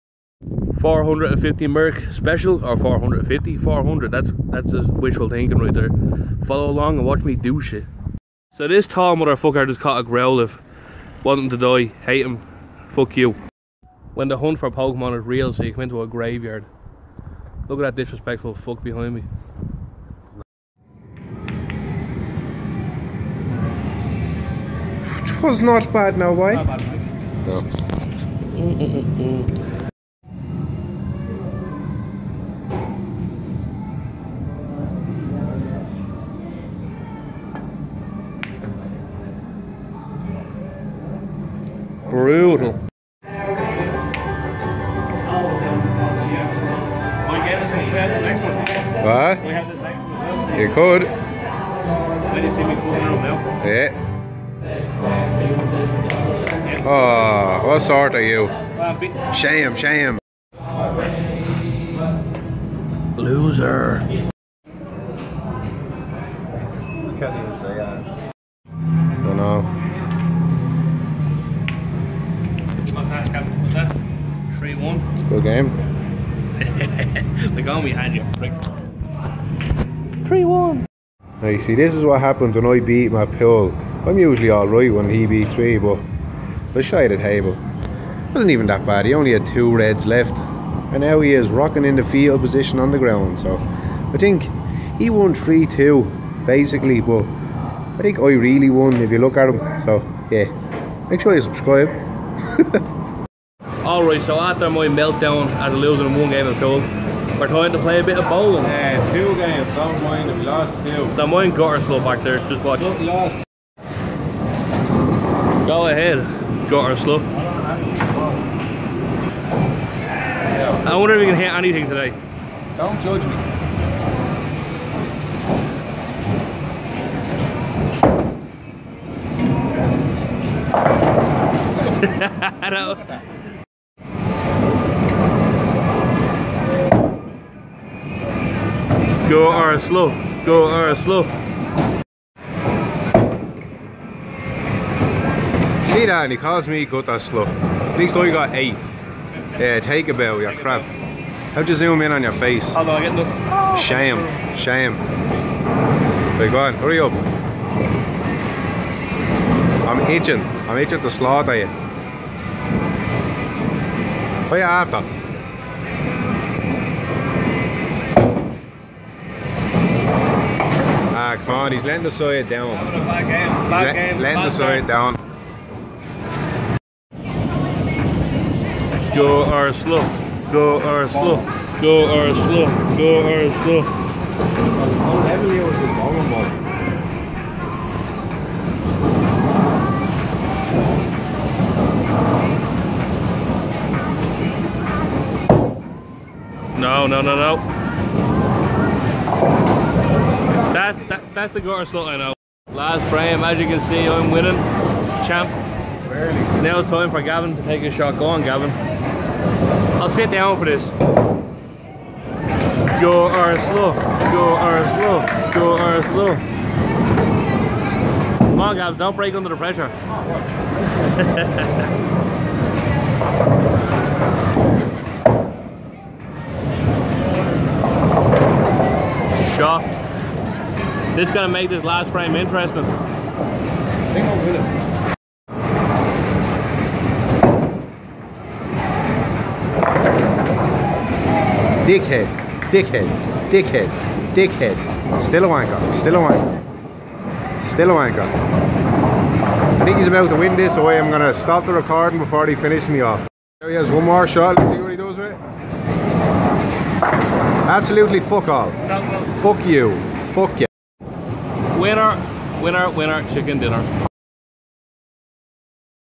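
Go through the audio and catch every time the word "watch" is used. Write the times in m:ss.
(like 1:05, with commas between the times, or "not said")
0:07, 1:52.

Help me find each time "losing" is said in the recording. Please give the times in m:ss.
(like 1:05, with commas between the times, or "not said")
1:45.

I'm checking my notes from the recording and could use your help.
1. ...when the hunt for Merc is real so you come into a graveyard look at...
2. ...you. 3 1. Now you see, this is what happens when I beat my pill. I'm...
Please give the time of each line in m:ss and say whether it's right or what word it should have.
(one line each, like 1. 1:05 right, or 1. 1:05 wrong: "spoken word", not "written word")
1. 0:14 wrong: "Pokemon", not "Merc"
2. 1:18 right.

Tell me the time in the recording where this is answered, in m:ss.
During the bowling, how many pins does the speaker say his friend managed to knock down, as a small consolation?
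2:28.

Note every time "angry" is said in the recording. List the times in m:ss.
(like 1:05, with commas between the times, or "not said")
not said.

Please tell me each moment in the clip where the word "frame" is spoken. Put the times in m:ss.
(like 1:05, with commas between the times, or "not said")
3:23, 3:52.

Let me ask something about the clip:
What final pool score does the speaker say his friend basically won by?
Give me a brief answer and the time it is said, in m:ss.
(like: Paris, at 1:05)
3-2, at 1:35.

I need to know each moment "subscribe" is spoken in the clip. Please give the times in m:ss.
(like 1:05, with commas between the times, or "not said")
1:41.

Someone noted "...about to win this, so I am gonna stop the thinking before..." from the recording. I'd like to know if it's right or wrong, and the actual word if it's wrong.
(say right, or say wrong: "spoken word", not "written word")
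wrong: "recording", not "thinking".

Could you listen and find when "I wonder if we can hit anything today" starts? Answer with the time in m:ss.
2:00.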